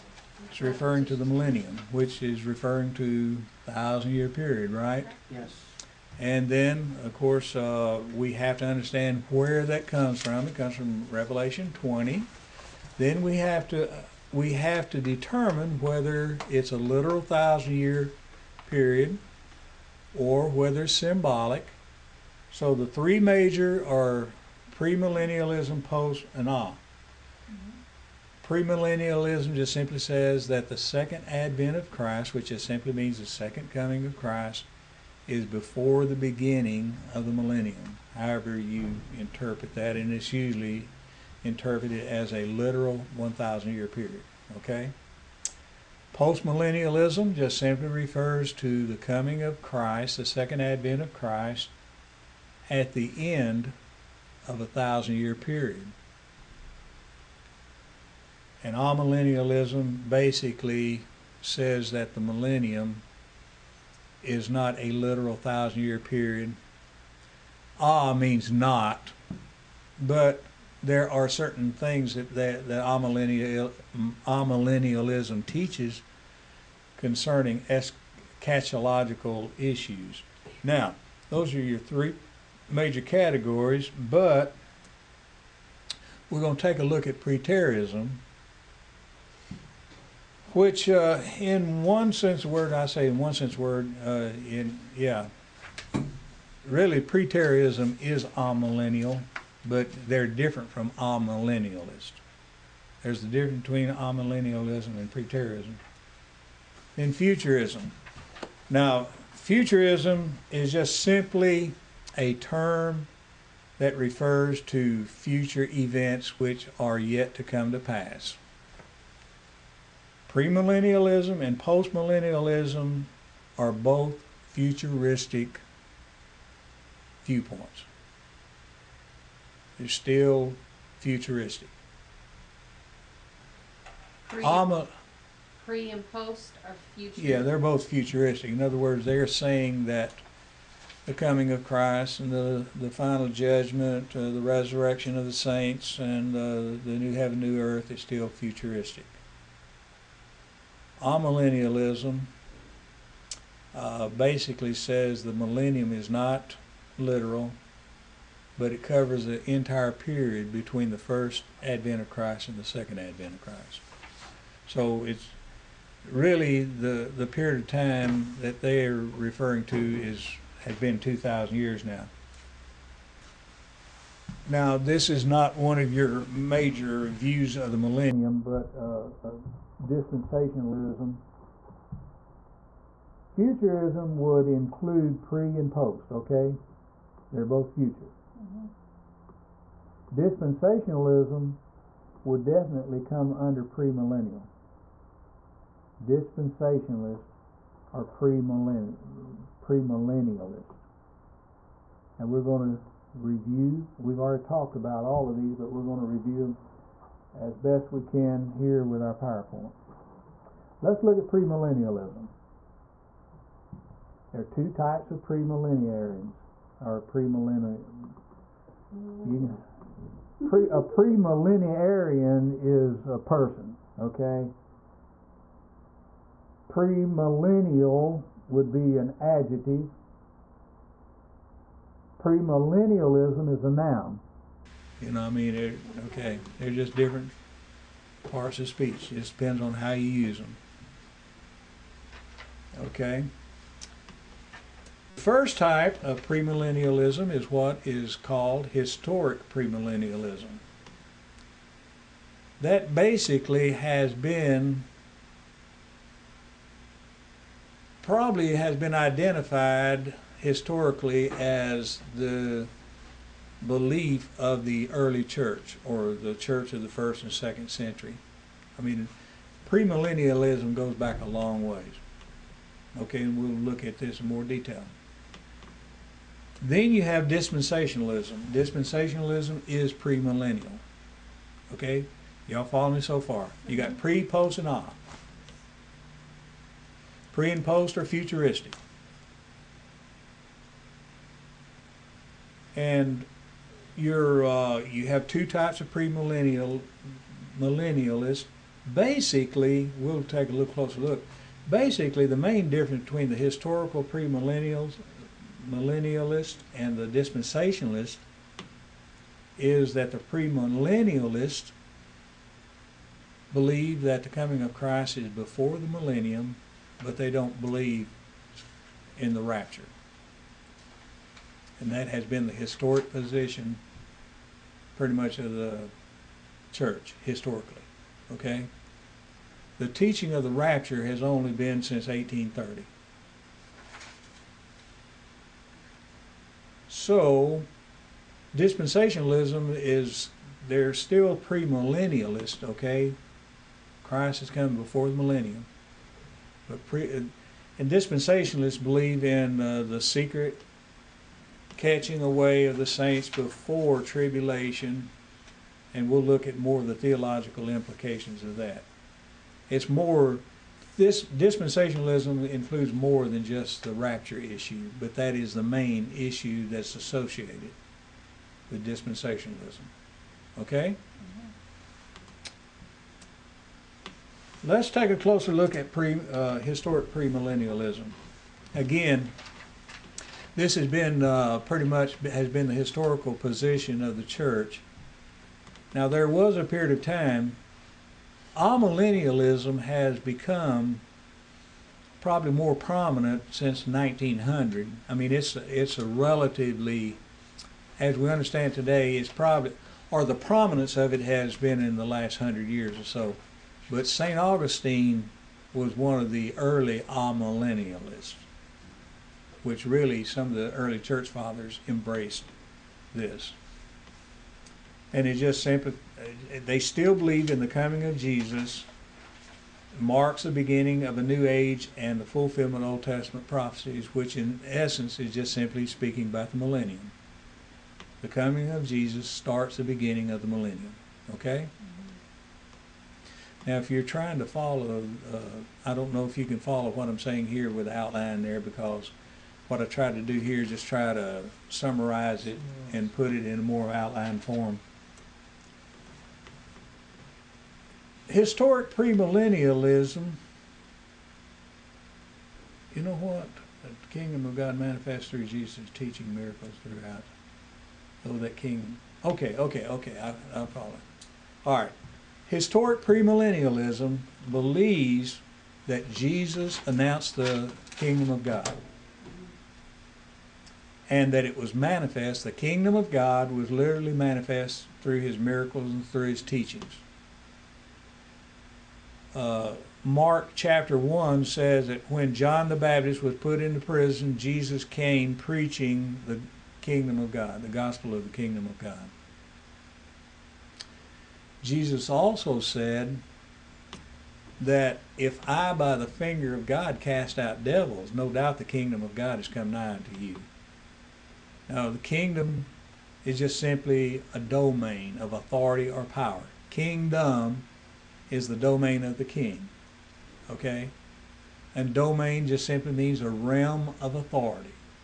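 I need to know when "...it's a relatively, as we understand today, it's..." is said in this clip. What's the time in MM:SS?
06:35.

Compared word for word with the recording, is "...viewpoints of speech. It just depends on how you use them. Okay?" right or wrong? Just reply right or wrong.
wrong.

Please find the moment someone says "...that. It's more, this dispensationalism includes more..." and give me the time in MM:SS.
05:58.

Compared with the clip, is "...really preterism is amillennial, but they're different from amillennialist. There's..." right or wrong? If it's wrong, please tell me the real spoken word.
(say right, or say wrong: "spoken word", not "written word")
right.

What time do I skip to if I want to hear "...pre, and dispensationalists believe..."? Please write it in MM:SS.
05:46.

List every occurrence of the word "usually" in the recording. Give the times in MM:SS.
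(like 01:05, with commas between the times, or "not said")
00:40.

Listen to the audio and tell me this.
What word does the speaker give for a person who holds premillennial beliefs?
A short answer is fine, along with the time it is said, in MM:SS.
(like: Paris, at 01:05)
premillennarian, at 03:40.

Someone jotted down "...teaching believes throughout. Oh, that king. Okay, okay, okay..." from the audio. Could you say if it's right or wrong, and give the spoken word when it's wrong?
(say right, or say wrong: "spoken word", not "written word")
wrong: "miracles", not "believes".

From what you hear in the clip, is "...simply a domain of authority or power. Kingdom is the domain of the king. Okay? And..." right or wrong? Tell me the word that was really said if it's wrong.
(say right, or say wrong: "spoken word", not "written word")
right.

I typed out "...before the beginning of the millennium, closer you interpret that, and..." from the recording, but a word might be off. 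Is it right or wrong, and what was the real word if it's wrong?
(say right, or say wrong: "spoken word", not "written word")
wrong: "however", not "closer".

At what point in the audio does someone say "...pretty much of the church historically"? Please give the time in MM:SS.
05:24.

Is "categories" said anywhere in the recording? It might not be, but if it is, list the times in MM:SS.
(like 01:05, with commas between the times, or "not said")
01:23.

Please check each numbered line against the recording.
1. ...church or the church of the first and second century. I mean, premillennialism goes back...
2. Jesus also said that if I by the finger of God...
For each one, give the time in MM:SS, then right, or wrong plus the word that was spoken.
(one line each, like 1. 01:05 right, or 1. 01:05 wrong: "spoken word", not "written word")
1. 04:25 right
2. 08:11 right.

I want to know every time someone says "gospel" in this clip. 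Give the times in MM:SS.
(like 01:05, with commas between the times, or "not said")
08:07.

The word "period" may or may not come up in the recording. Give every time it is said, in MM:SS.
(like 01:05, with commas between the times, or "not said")
00:04, 00:18, 00:43, 00:55, 01:05, 02:39, 02:47, 06:26.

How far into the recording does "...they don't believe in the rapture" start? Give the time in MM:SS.
05:17.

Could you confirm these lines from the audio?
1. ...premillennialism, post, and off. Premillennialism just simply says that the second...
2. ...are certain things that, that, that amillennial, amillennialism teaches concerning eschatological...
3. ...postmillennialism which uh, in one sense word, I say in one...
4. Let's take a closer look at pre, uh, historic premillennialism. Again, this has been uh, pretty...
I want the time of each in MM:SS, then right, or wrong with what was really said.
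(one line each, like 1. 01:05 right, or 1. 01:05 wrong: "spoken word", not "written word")
1. 00:24 right
2. 01:11 right
3. 01:27 wrong: "preterism", not "postmillennialism"
4. 06:14 right.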